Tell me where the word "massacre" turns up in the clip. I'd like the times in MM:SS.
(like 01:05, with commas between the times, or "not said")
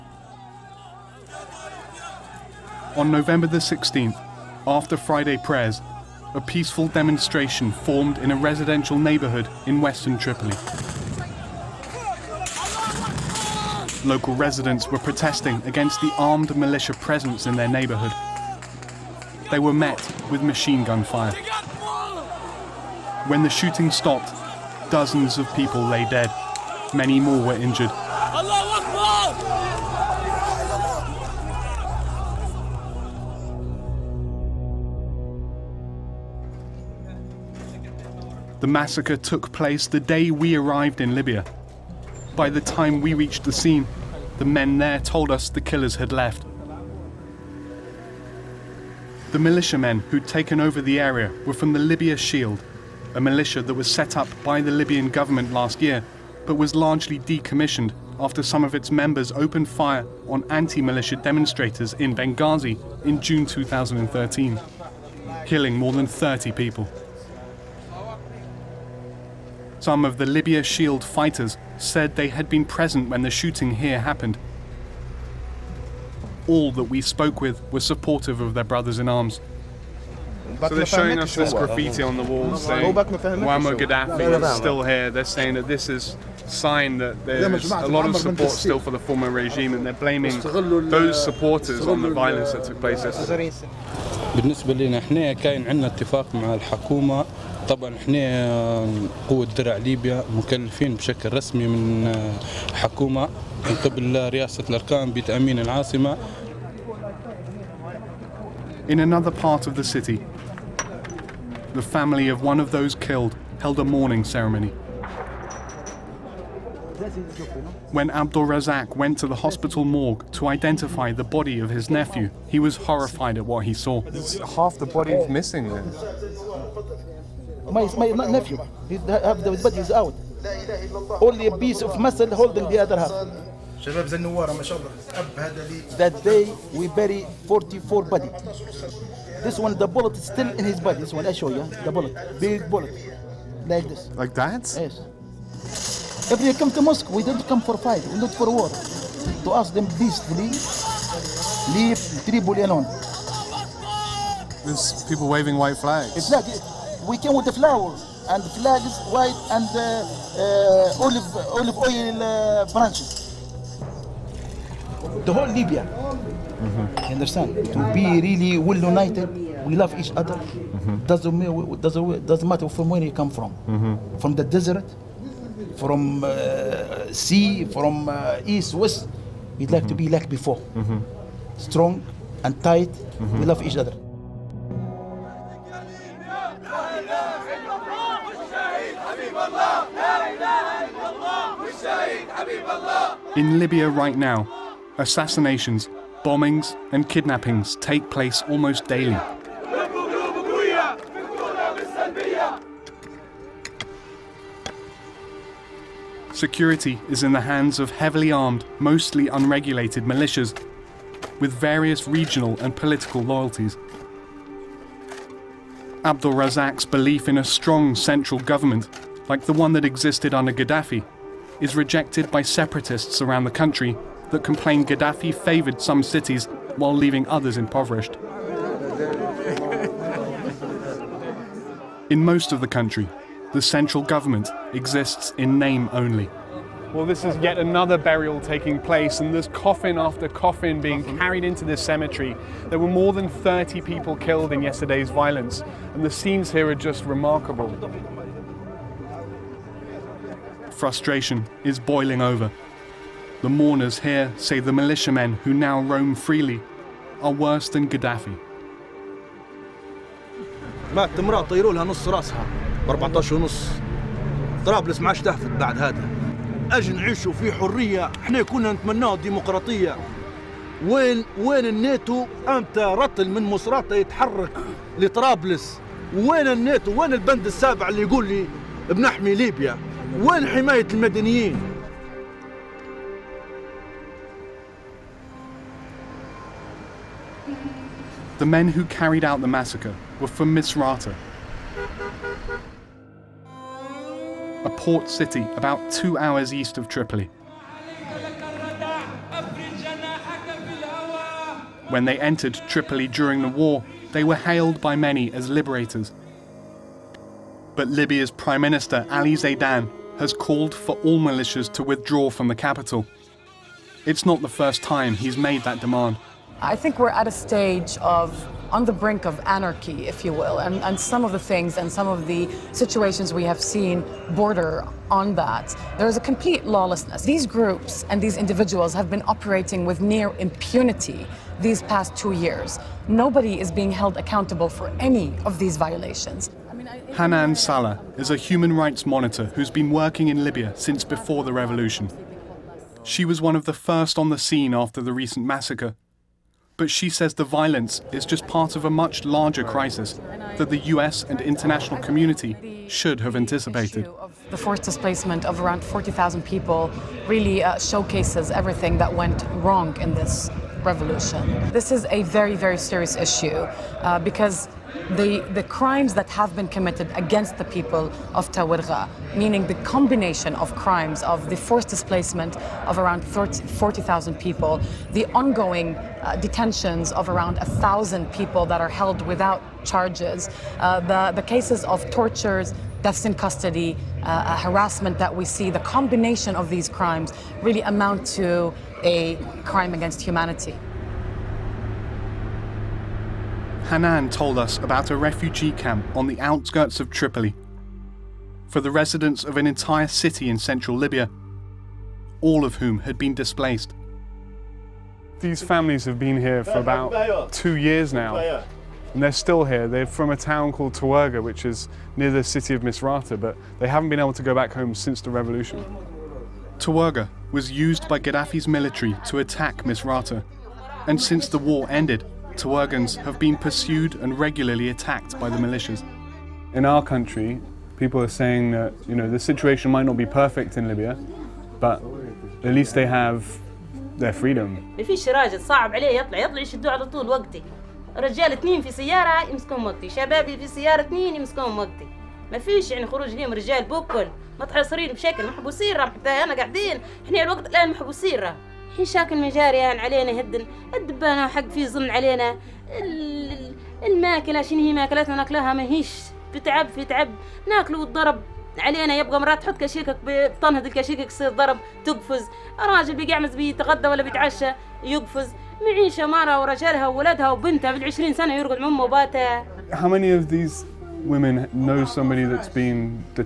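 00:38, 04:49, 05:45.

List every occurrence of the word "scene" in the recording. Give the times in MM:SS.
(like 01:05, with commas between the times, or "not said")
00:43, 04:06, 05:44.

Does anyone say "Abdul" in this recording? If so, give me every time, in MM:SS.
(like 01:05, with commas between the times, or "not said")
01:58, 03:36.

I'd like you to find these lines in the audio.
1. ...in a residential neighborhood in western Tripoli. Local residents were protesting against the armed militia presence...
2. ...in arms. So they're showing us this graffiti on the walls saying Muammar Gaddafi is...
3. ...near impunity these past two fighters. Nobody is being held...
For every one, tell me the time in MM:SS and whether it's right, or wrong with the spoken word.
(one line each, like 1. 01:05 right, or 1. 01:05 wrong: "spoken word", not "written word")
1. 00:08 right
2. 01:19 right
3. 05:30 wrong: "years", not "fighters".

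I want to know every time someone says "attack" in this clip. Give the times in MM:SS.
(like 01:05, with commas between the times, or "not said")
06:59.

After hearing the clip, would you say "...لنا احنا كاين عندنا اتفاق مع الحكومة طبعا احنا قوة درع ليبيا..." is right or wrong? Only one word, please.
right.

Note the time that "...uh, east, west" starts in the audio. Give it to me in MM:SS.
02:58.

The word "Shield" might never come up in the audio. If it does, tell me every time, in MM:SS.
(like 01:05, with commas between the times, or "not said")
00:52, 01:10.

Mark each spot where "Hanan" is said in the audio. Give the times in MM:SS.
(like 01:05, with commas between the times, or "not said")
05:37, 06:33.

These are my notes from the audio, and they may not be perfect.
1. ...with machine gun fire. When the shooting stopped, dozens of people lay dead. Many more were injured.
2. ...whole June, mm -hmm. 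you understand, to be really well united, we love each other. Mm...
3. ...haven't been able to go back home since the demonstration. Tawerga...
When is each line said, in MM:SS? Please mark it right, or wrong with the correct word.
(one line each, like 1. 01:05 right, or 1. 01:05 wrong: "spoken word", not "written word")
1. 00:20 right
2. 02:45 wrong: "Libya", not "June"
3. 06:53 wrong: "revolution", not "demonstration".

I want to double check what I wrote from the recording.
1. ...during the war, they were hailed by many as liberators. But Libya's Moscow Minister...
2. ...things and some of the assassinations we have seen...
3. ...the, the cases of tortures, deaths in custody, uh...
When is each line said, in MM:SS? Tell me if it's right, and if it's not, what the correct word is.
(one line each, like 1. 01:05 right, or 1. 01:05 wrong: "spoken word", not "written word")
1. 05:03 wrong: "Prime", not "Moscow"
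2. 05:21 wrong: "situations", not "assassinations"
3. 06:21 right.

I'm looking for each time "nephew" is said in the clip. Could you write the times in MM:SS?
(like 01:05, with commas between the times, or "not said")
02:01, 02:08.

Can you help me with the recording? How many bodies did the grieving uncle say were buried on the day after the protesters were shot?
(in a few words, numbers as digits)
44.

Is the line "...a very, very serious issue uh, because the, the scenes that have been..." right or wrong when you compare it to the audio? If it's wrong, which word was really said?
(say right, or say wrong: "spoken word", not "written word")
wrong: "crimes", not "scenes".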